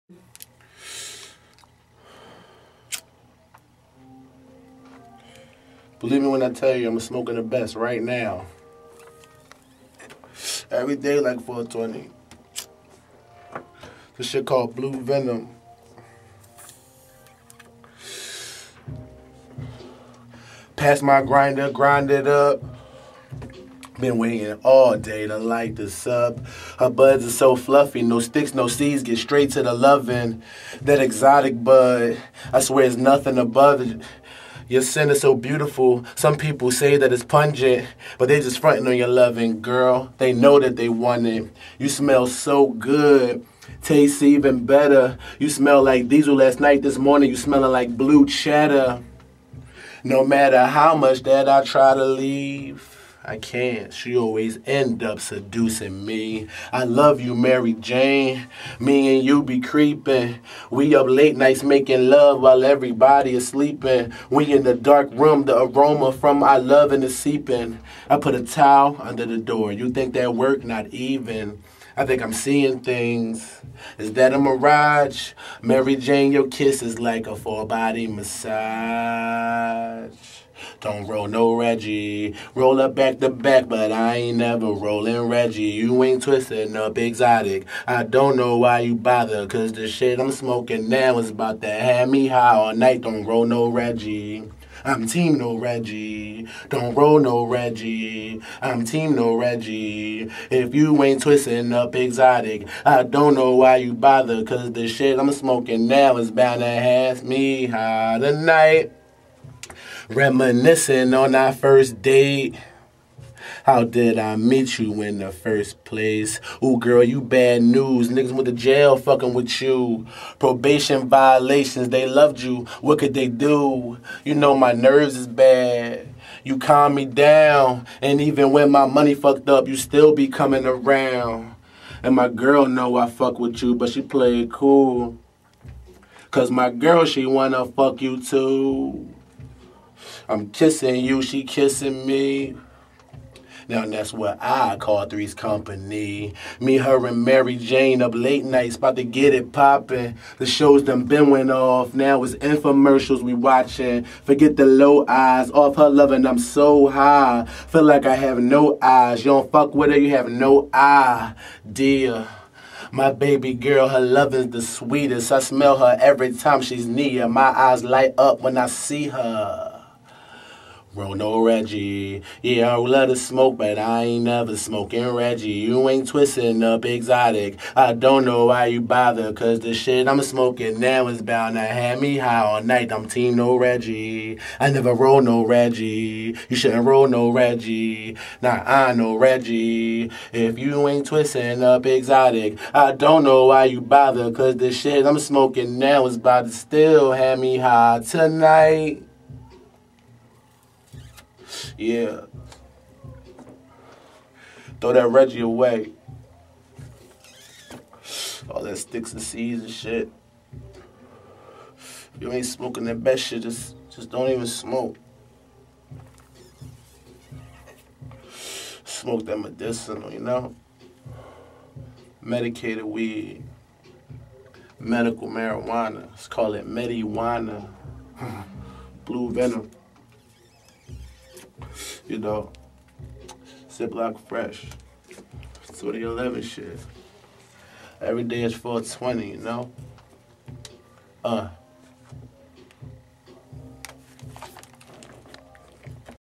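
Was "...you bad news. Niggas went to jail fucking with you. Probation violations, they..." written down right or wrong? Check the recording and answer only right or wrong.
right.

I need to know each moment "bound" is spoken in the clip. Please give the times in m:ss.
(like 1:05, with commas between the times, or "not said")
1:46, 3:01.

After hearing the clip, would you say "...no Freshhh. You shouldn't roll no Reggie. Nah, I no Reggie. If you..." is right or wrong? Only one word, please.
wrong.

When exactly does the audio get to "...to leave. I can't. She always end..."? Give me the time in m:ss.
0:51.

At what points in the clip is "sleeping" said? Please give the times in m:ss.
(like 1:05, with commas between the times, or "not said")
1:03.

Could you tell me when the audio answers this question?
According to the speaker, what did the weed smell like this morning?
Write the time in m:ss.
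0:47.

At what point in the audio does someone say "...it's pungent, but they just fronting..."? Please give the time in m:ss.
0:37.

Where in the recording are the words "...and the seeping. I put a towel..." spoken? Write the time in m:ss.
1:06.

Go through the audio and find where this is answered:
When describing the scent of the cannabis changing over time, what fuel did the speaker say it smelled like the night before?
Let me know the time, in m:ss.
0:46.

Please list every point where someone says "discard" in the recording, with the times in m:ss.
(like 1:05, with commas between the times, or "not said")
not said.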